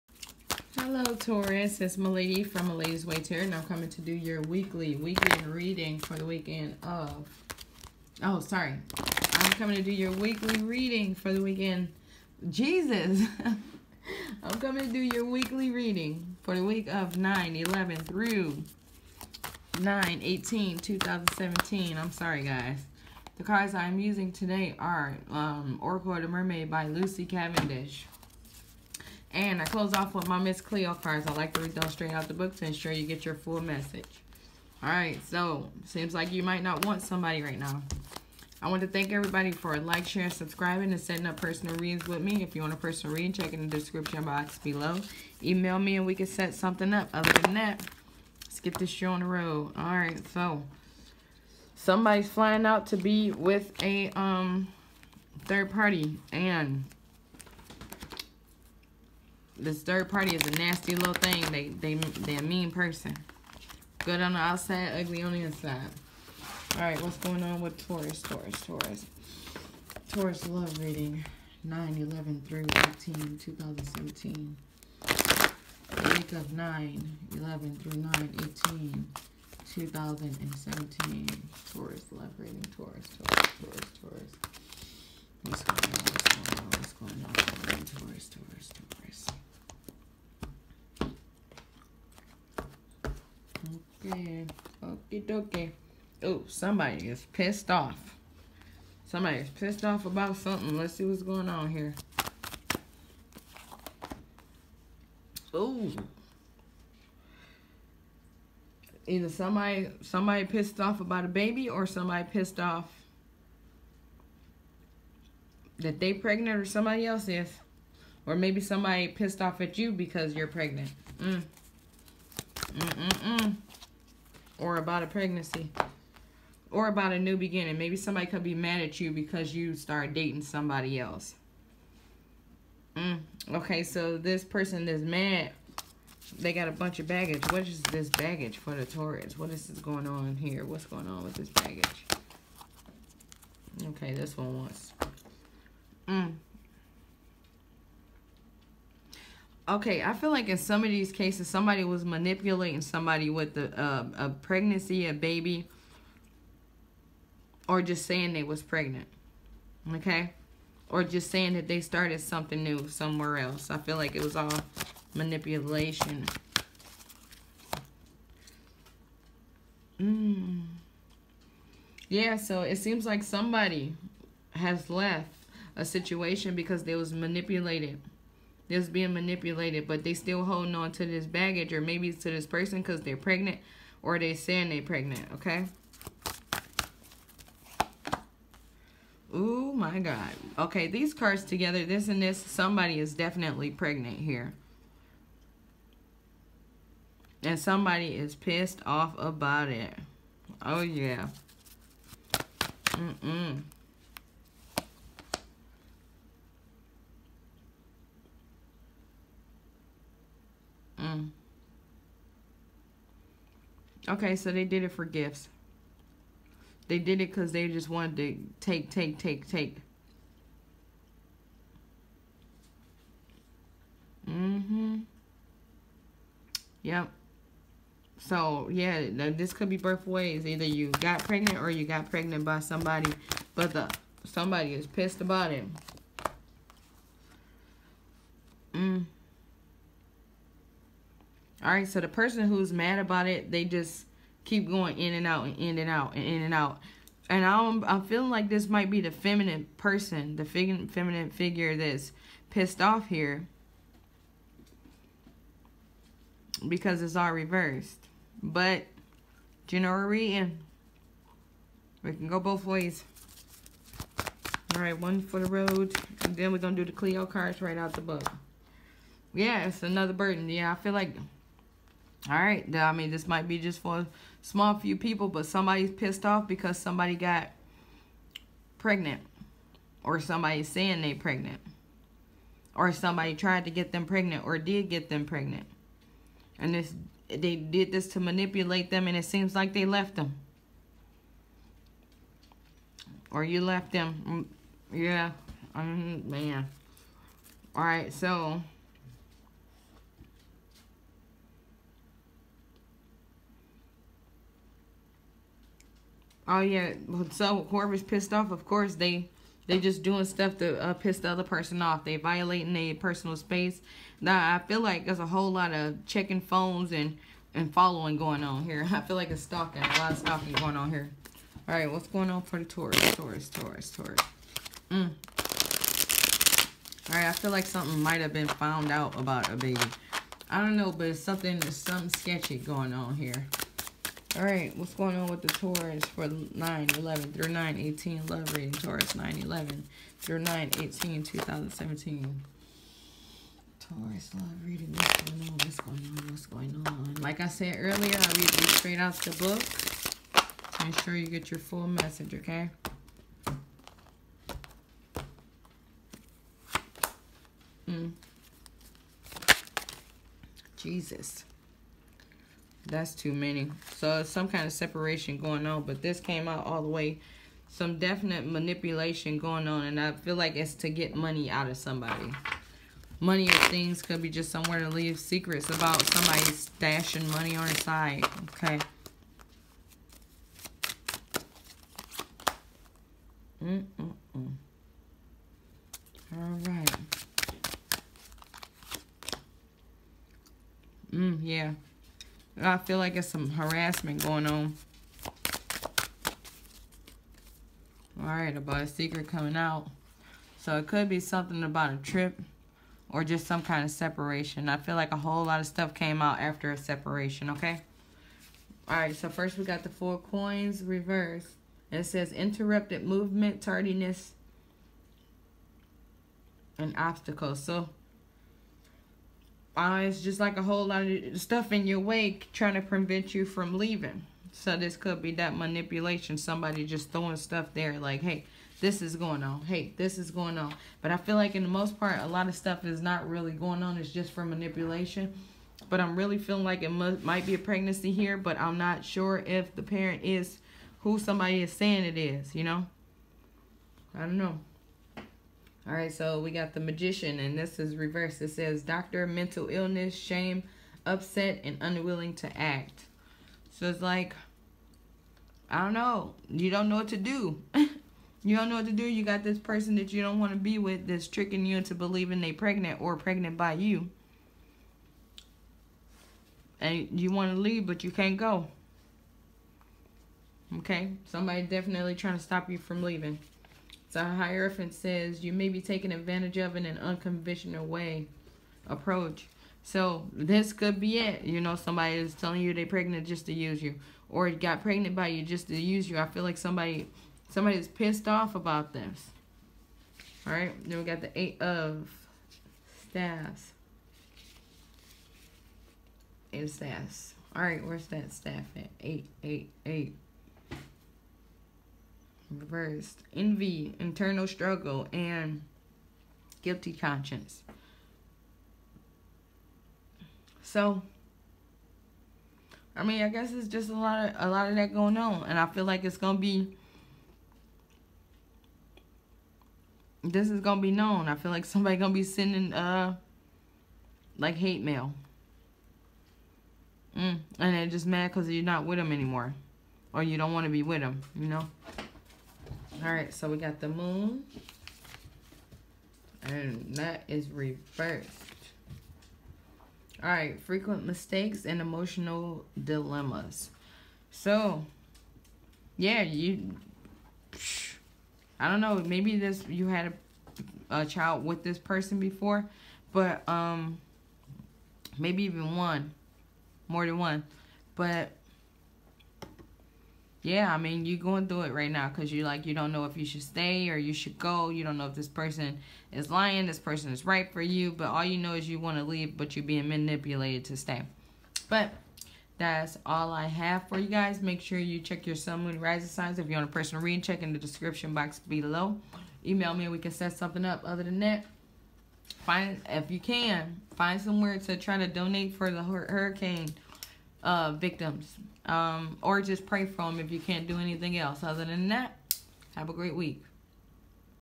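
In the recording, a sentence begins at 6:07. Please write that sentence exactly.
Some definite manipulation going on, and I feel like it's to get money out of somebody.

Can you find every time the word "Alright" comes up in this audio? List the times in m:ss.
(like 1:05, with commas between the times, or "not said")
8:10, 8:17.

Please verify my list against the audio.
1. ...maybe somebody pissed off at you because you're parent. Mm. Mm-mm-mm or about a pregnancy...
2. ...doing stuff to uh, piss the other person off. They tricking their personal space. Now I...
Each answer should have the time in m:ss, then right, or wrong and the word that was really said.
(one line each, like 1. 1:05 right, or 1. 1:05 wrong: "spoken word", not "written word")
1. 1:58 wrong: "pregnant", not "parent"
2. 5:10 wrong: "violating", not "tricking".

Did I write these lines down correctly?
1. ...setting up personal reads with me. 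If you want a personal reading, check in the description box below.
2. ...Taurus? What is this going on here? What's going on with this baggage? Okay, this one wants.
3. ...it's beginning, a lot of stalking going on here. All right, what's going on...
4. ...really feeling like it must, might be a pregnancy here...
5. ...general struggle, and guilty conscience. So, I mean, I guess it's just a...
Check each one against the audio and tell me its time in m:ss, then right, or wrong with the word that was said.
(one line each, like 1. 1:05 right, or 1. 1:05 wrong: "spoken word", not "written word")
1. 0:40 right
2. 2:18 right
3. 5:19 wrong: "stalking", not "beginning"
4. 7:16 right
5. 8:23 wrong: "internal", not "general".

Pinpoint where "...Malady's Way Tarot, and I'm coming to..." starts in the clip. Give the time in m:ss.
0:02.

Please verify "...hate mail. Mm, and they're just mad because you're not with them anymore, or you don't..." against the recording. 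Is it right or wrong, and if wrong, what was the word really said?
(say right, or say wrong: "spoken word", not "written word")
right.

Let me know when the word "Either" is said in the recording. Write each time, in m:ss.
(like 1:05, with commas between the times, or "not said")
1:49, 3:50.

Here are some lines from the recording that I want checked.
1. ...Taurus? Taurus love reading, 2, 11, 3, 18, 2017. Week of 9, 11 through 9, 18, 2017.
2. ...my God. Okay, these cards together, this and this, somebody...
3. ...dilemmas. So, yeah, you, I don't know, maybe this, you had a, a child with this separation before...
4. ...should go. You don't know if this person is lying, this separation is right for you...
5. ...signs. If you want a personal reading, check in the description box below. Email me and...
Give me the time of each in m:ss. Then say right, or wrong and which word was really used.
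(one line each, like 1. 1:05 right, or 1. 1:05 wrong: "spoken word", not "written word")
1. 1:08 wrong: "9", not "2"
2. 3:09 right
3. 9:02 wrong: "person", not "separation"
4. 9:24 wrong: "person", not "separation"
5. 9:36 right.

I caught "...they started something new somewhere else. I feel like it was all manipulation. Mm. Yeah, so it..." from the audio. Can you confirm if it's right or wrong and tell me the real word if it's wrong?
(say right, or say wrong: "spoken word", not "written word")
right.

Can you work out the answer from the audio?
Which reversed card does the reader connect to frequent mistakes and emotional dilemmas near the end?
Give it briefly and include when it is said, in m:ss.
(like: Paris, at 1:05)
The Moon, at 8:53.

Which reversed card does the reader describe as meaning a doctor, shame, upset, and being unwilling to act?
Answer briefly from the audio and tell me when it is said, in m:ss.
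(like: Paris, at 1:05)
The Magician, at 7:26.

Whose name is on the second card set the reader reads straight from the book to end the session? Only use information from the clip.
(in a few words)
Miss Cleo.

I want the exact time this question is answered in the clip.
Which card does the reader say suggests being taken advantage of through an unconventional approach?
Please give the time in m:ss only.
7:54.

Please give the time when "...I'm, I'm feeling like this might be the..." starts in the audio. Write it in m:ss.
4:07.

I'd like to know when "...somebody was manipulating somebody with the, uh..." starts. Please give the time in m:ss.
2:31.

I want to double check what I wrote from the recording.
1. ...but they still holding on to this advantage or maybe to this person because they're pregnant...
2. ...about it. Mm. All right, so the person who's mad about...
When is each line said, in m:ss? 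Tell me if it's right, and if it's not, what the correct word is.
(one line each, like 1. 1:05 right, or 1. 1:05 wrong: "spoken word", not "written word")
1. 2:59 wrong: "baggage", not "advantage"
2. 3:55 right.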